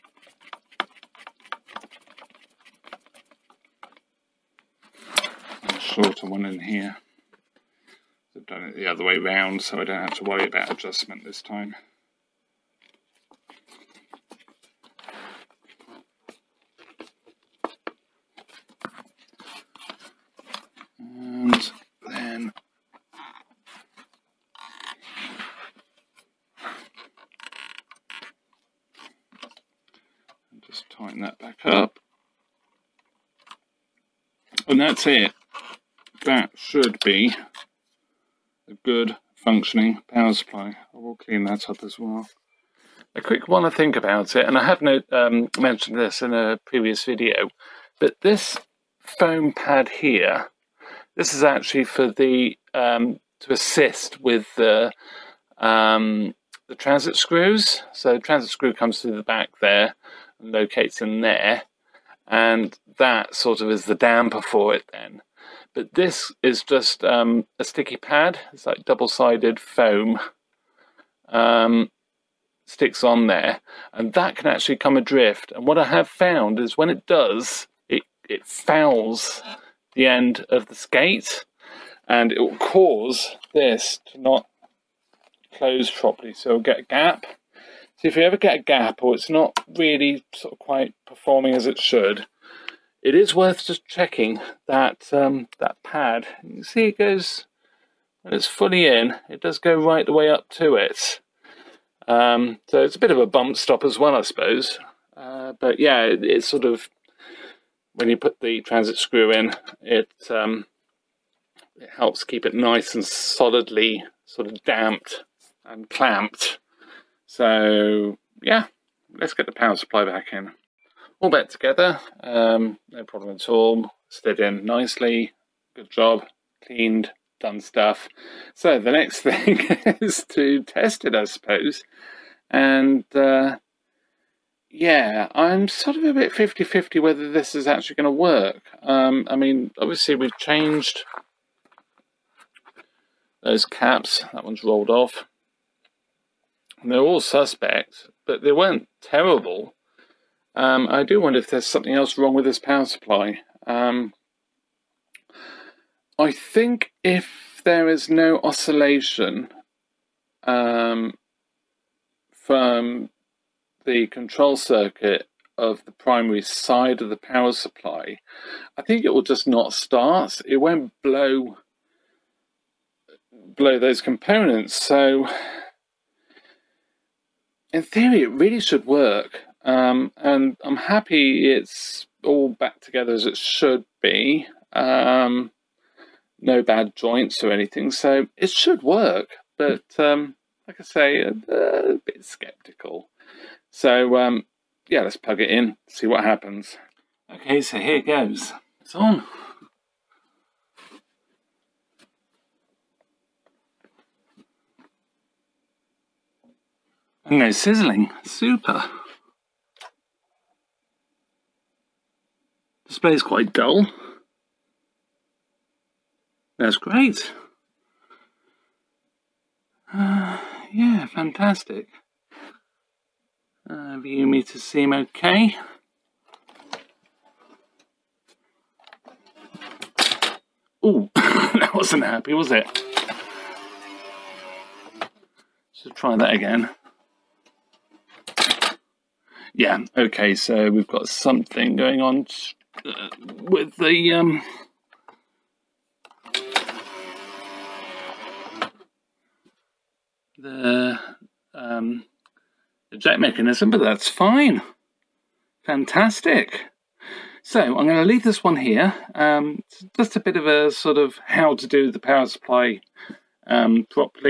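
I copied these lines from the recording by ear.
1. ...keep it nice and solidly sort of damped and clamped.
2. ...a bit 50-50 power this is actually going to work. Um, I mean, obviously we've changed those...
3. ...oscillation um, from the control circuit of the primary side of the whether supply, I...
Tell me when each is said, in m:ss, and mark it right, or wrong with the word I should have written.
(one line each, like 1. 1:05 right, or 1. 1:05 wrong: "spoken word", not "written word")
1. 1:52 right
2. 2:16 wrong: "whether", not "power"
3. 2:38 wrong: "power", not "whether".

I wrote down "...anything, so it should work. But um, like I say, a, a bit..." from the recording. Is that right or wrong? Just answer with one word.
right.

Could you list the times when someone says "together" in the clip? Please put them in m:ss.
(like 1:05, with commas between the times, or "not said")
2:01, 3:02.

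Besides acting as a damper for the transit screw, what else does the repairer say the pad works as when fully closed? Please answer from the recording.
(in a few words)
A bump stop.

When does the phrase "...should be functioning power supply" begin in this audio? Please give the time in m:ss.
0:36.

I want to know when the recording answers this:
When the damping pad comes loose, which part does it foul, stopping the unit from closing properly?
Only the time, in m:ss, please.
1:20.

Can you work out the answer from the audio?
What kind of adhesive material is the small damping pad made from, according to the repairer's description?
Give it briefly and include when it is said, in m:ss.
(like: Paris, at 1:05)
Double-sided foam, at 1:08.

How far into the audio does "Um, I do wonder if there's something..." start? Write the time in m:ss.
2:30.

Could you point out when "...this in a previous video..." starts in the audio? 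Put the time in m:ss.
0:45.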